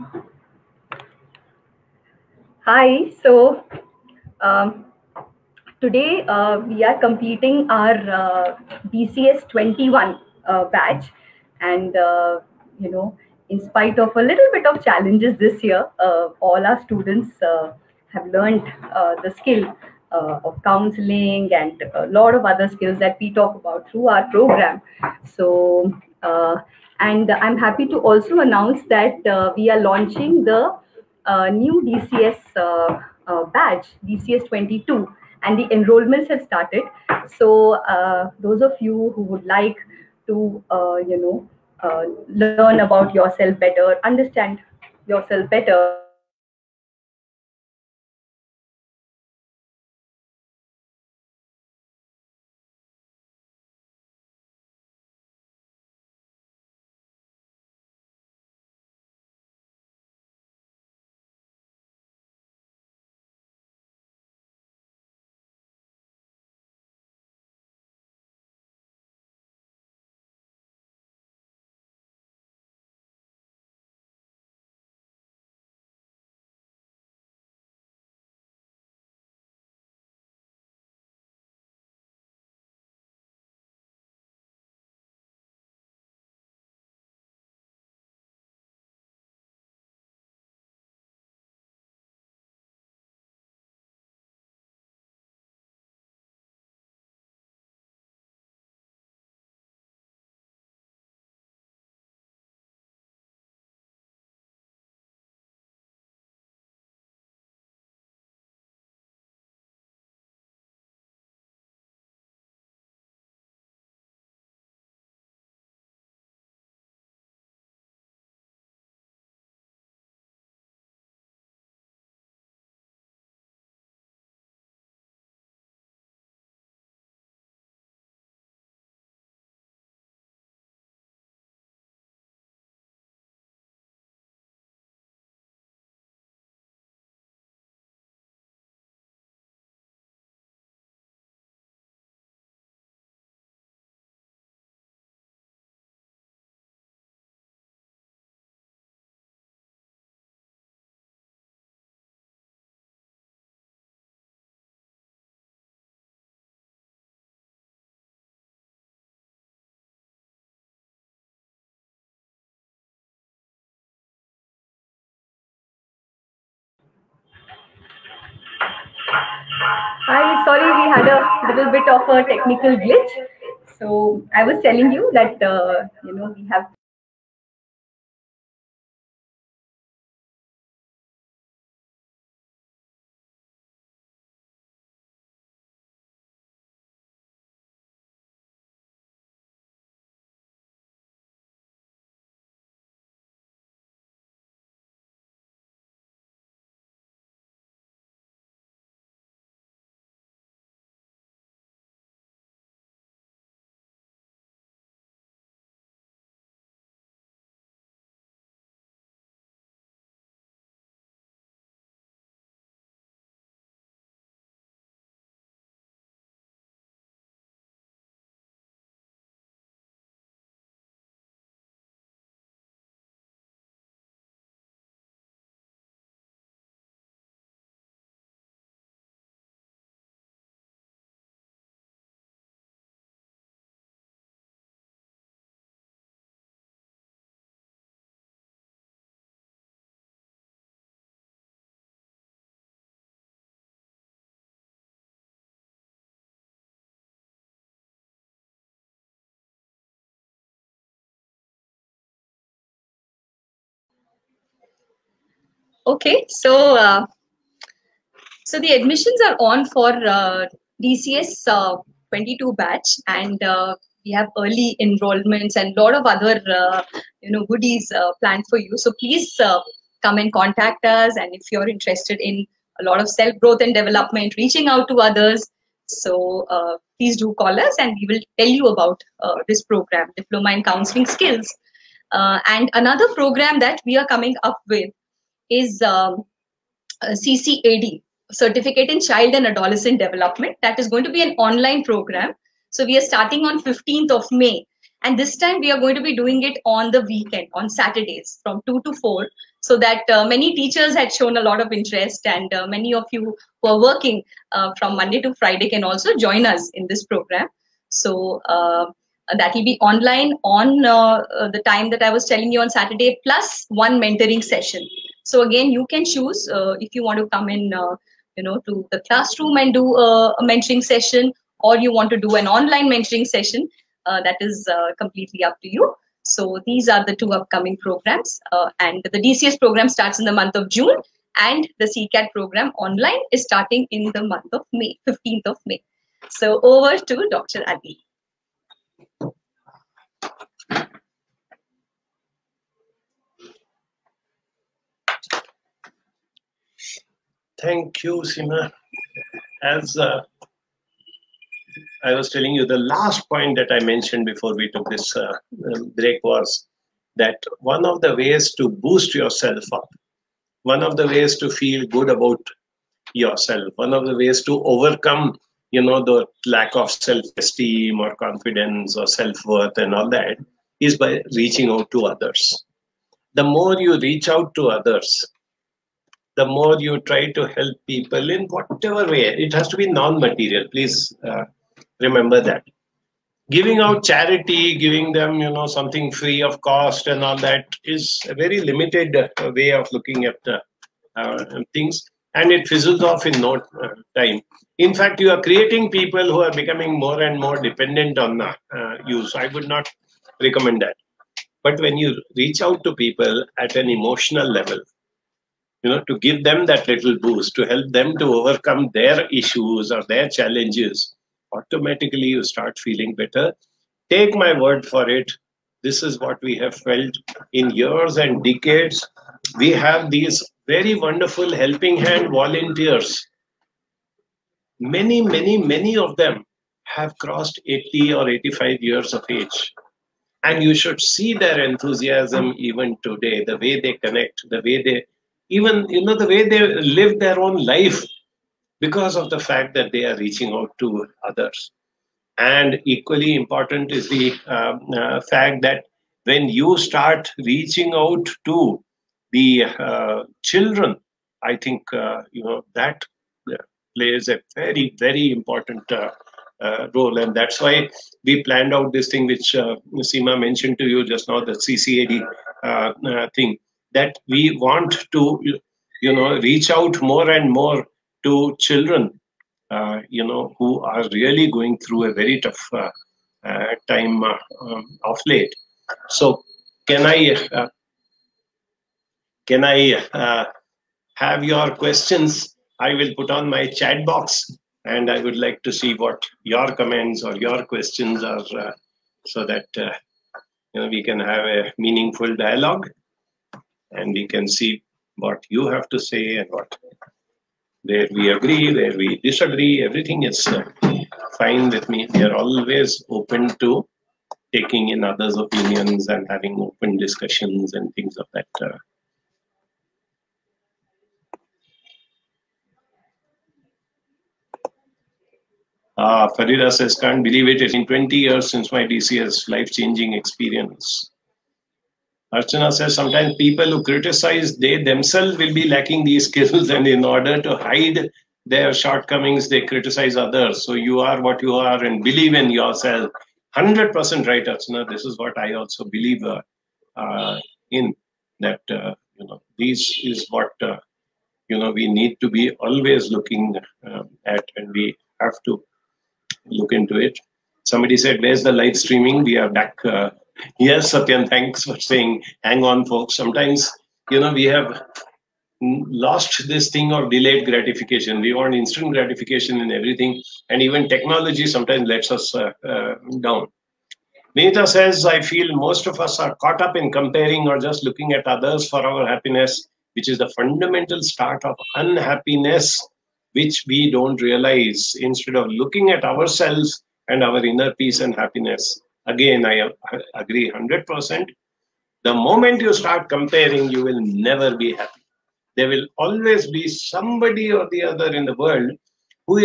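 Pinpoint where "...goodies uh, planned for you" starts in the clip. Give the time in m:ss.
4:27.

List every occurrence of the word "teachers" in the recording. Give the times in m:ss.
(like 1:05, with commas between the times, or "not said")
5:00.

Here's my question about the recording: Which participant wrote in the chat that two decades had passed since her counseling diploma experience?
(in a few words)
Farida.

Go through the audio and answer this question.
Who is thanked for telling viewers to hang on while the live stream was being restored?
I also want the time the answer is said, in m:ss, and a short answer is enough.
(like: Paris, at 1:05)
Satyan, at 9:10.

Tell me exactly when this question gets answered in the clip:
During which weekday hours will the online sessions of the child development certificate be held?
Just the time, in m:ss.
4:58.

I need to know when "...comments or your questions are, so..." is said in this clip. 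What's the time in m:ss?
8:06.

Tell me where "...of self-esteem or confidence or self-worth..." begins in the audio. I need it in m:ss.
6:06.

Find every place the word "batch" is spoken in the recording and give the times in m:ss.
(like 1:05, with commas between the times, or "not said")
0:10, 4:22.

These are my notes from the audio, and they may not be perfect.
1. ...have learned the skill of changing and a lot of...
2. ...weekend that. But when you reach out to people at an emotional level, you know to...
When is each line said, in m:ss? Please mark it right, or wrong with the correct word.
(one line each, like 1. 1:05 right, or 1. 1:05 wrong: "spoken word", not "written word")
1. 0:18 wrong: "counseling", not "changing"
2. 6:40 wrong: "recommend", not "weekend".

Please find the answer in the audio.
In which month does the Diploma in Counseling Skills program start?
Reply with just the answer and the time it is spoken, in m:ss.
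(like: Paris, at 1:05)
June, at 5:30.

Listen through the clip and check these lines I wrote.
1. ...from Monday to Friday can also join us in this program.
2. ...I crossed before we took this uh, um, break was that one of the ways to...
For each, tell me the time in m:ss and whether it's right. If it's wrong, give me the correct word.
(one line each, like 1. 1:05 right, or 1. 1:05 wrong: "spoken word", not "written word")
1. 5:04 right
2. 5:53 wrong: "mentioned", not "crossed".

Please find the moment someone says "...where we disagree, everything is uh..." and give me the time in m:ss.
8:18.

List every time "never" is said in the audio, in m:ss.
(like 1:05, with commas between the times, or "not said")
9:44.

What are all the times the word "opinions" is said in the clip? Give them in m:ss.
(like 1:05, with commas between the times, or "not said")
8:25.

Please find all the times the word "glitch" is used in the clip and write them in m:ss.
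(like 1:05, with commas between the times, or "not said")
2:52.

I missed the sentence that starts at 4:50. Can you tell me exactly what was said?
That is going to be an online program.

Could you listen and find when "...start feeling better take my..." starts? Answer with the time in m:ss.
6:52.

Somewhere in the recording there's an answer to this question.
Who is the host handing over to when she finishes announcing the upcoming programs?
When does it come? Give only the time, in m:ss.
5:37.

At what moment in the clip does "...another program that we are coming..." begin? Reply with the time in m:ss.
4:42.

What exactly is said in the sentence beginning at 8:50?
So you are what you are and believe in yourself.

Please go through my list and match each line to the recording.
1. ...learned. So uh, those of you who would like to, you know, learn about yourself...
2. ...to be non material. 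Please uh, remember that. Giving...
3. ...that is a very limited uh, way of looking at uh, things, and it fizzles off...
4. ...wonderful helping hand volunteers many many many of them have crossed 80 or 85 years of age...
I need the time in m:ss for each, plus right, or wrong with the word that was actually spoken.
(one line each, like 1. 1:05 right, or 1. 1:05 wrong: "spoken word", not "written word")
1. 0:36 wrong: "started", not "learned"
2. 6:19 right
3. 6:27 right
4. 7:01 right.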